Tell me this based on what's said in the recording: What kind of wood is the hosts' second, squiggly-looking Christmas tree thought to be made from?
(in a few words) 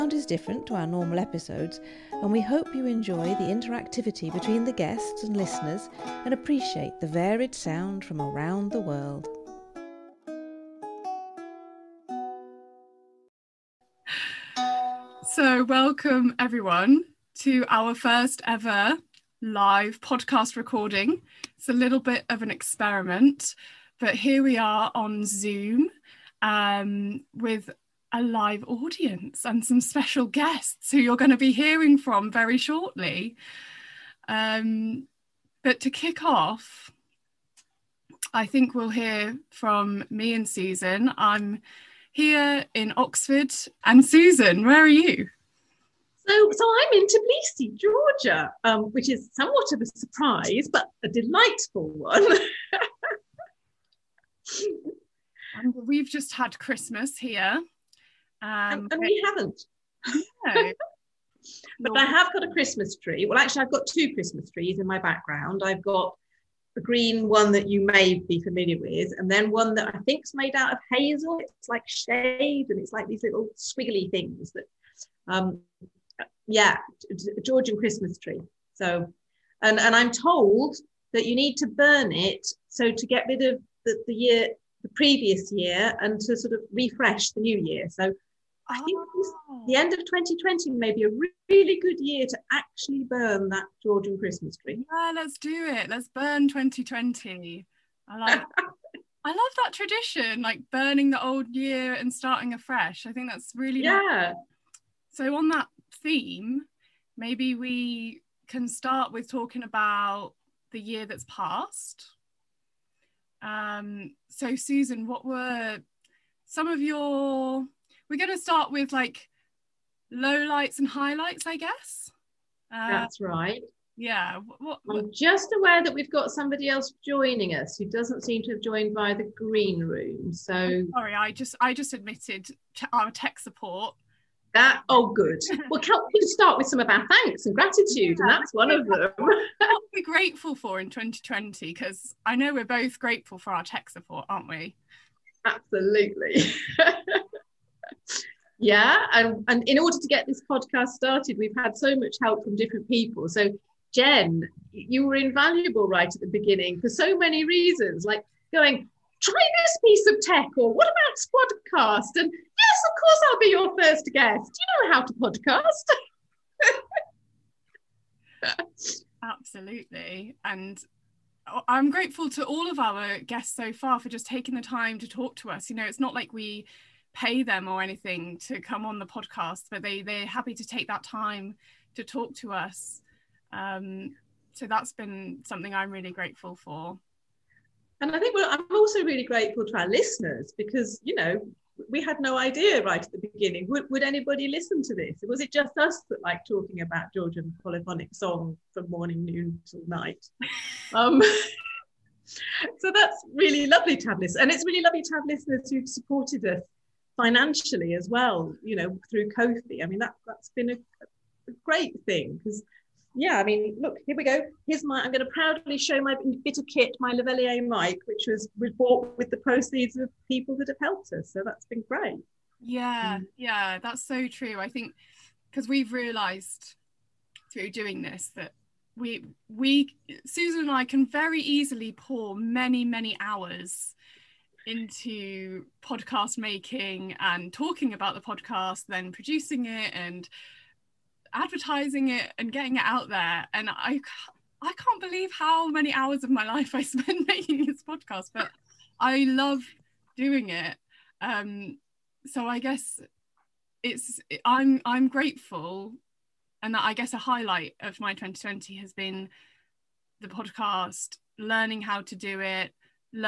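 Hazel.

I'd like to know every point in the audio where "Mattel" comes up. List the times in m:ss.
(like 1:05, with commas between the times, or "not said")
not said.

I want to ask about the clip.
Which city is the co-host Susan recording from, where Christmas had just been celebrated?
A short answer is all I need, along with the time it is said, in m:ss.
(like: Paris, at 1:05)
Tbilisi, at 0:47.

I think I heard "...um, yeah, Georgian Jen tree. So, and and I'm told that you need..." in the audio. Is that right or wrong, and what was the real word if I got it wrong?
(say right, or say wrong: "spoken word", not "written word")
wrong: "Christmas", not "Jen".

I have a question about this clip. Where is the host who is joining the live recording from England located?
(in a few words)
Oxford.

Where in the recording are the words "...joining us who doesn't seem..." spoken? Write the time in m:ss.
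2:07.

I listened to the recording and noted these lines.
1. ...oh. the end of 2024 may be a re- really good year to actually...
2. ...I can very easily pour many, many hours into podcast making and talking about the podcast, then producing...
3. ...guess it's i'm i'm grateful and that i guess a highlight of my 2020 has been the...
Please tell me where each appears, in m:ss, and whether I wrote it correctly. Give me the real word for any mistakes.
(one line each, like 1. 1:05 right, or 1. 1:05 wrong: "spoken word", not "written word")
1. 1:29 wrong: "2020", not "2024"
2. 3:50 right
3. 4:12 right.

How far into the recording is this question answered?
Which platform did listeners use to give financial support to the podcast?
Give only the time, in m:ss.
3:29.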